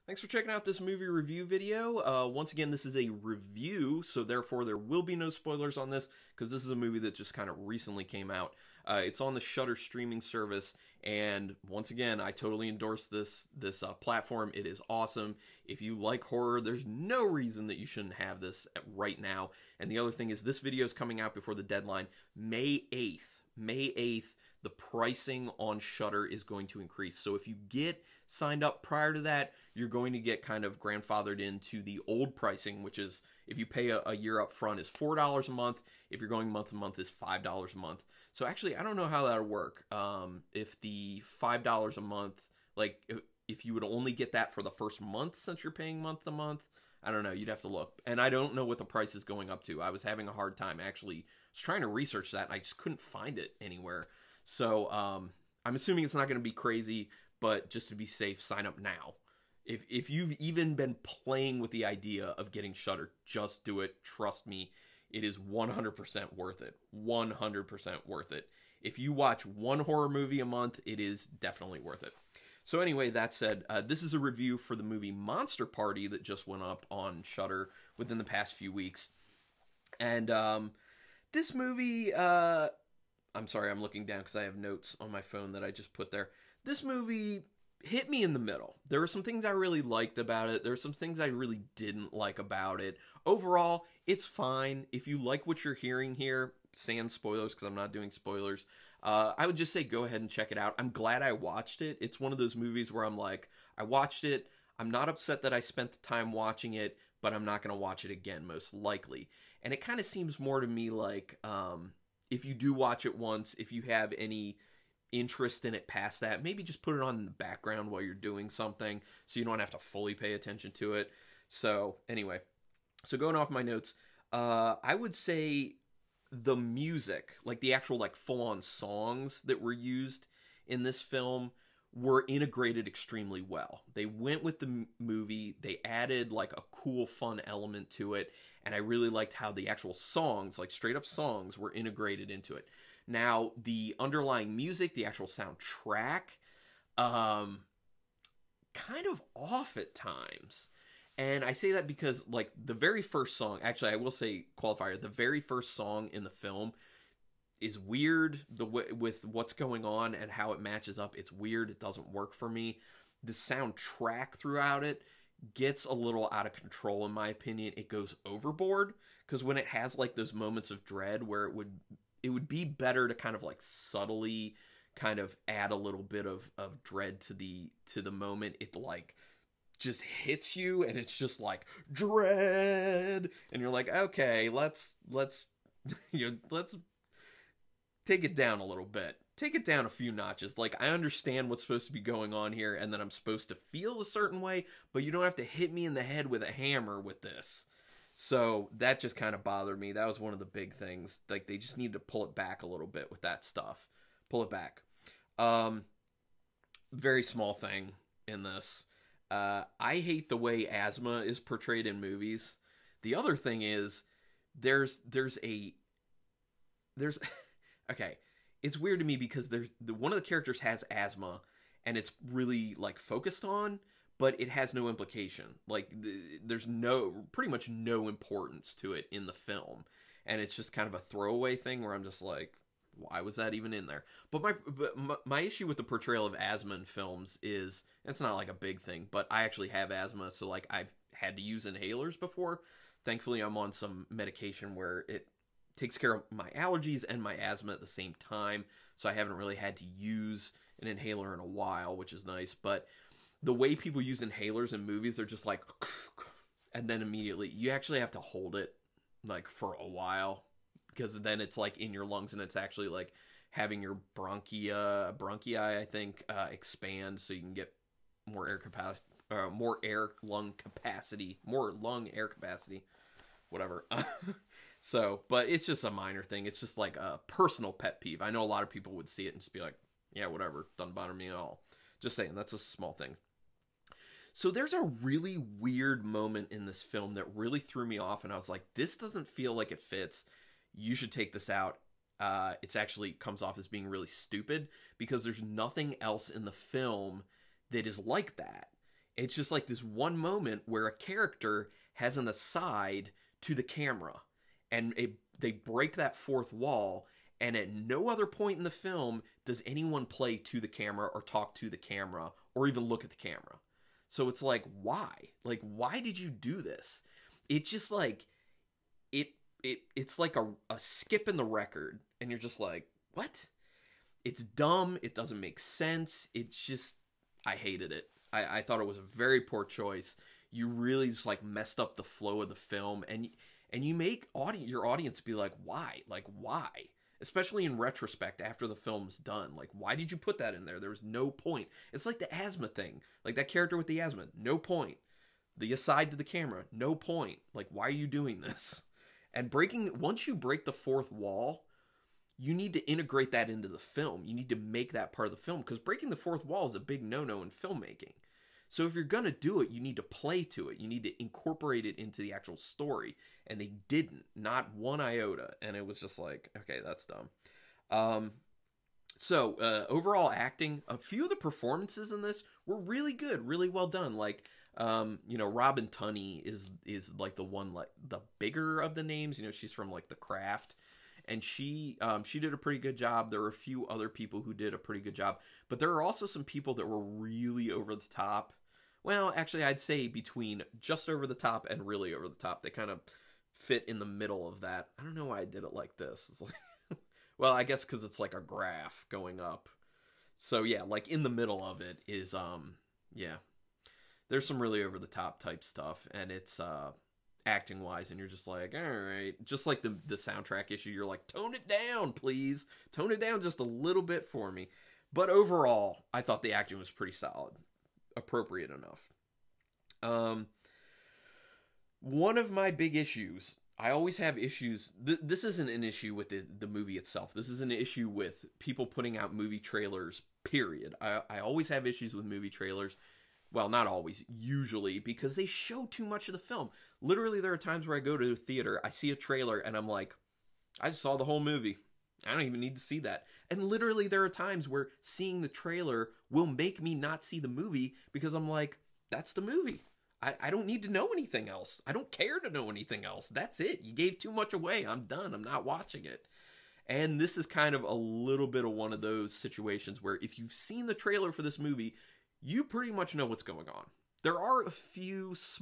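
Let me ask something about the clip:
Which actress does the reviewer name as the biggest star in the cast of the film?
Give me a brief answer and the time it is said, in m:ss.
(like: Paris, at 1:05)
Robin Tunney, at 6:15.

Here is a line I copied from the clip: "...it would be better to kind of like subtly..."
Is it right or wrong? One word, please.
right.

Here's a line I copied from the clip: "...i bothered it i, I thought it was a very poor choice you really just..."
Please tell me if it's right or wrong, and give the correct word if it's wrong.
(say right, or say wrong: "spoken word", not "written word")
wrong: "hated", not "bothered".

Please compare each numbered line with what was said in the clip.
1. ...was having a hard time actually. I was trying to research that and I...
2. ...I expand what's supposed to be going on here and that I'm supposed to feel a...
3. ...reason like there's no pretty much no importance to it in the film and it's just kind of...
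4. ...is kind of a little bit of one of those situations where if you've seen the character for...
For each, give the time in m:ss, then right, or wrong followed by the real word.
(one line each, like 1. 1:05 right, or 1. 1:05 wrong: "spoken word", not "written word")
1. 0:49 right
2. 3:10 wrong: "understand", not "expand"
3. 3:44 wrong: "implication", not "reason"
4. 7:37 wrong: "trailer", not "character".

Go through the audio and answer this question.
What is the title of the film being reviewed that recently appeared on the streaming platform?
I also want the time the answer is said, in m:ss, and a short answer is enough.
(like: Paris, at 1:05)
Monster Party, at 1:15.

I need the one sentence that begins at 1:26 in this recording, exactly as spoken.
This movie hit me in the middle.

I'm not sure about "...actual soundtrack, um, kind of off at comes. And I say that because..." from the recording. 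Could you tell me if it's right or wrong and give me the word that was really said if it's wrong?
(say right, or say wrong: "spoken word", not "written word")
wrong: "times", not "comes".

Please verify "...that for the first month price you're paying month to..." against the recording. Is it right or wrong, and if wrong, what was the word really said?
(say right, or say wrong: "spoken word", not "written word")
wrong: "since", not "price".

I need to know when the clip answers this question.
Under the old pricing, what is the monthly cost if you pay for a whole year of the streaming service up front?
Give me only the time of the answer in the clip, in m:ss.
0:34.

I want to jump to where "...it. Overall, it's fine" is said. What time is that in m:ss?
1:32.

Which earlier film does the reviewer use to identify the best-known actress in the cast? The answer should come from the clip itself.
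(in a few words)
The Craft.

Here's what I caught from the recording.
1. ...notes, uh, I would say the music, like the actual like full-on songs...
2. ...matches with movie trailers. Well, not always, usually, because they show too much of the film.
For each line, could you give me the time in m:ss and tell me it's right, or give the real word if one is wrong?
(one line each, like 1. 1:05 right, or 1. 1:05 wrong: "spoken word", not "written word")
1. 2:03 right
2. 7:11 wrong: "issues", not "matches".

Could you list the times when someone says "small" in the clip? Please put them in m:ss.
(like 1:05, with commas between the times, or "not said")
3:27, 4:42.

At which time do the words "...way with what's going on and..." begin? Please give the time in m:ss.
2:38.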